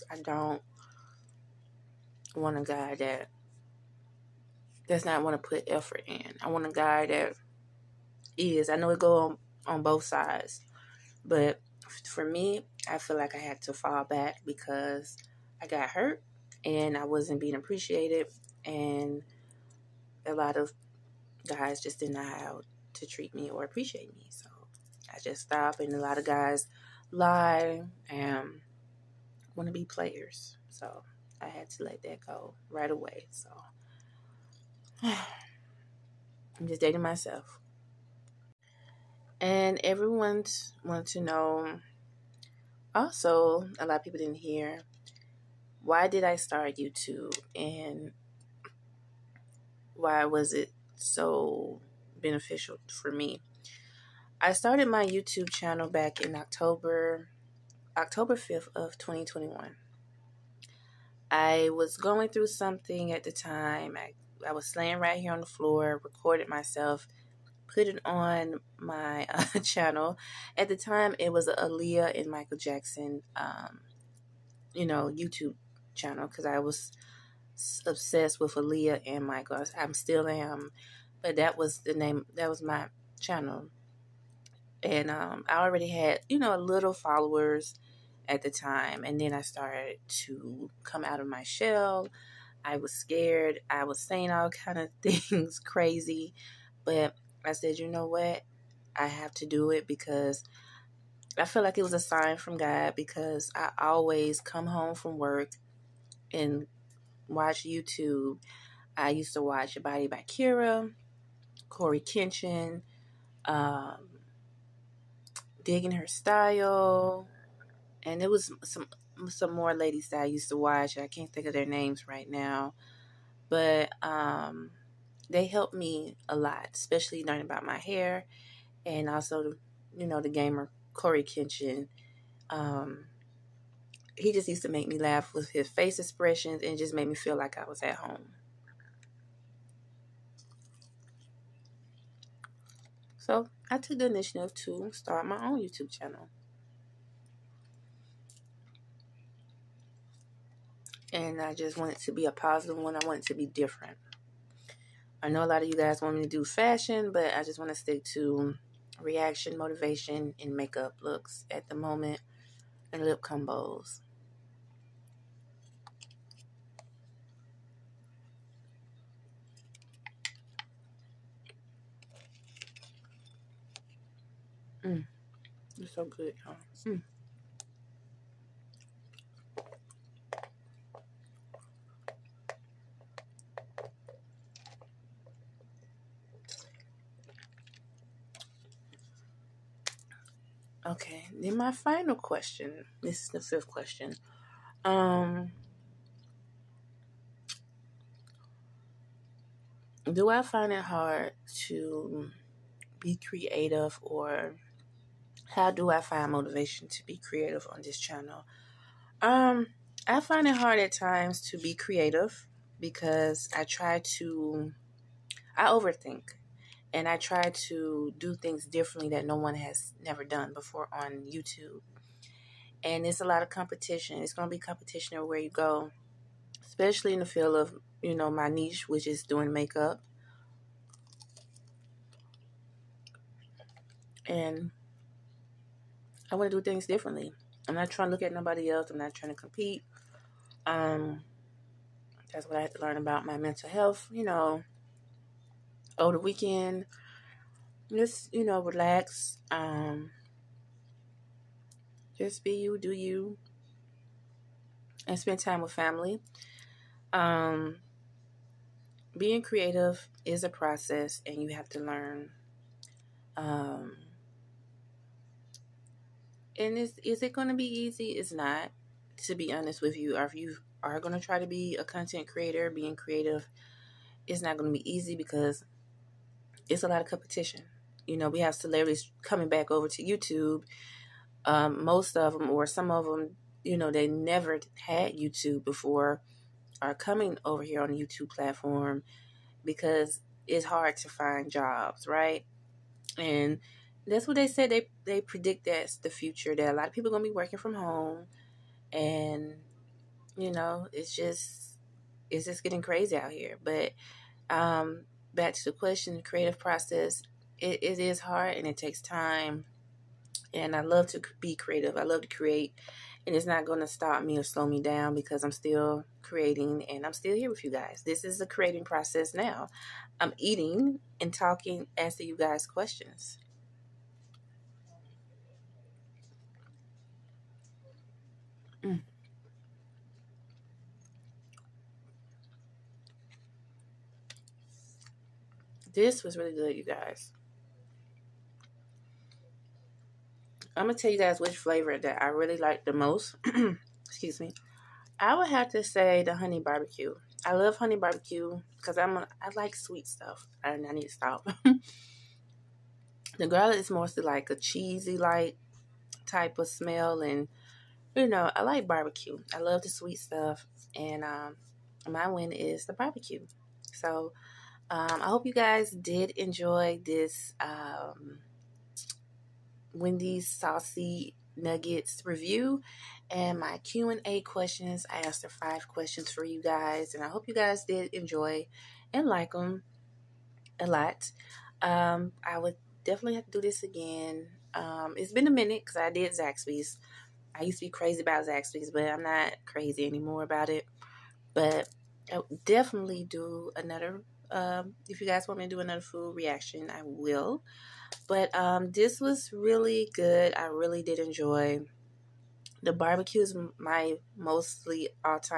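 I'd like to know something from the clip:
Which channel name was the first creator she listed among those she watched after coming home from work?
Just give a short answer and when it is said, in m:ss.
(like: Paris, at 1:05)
Body by Kira, at 1:49.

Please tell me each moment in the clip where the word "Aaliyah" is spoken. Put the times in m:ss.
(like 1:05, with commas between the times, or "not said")
1:11, 1:18.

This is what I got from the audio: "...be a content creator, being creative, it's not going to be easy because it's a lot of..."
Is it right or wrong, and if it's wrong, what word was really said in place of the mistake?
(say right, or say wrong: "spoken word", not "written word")
right.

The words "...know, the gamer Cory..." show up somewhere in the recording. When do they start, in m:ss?
2:10.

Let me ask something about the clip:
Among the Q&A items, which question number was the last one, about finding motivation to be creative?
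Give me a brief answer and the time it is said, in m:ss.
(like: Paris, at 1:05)
5th, at 3:13.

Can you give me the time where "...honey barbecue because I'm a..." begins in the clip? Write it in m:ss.
5:47.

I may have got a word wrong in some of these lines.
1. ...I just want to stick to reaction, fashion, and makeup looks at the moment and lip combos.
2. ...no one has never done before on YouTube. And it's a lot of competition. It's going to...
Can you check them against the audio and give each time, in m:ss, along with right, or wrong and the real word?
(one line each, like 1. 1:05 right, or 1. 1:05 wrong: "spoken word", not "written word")
1. 2:37 wrong: "motivation", not "fashion"
2. 3:39 right.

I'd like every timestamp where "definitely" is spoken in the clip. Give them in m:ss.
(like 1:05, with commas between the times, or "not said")
6:23, 6:32.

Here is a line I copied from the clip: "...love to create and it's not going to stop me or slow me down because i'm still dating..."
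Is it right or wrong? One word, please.
wrong.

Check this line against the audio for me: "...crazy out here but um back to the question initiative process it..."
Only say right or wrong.
wrong.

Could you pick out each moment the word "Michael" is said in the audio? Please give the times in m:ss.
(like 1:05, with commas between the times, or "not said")
1:12, 1:19.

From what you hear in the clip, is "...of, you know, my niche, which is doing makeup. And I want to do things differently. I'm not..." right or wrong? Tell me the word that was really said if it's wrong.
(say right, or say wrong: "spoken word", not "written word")
right.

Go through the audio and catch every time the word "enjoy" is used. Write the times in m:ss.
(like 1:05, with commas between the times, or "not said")
6:06, 6:18, 6:41.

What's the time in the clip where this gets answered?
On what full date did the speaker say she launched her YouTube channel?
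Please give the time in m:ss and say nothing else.
0:57.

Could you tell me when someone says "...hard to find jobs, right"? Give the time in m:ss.
4:50.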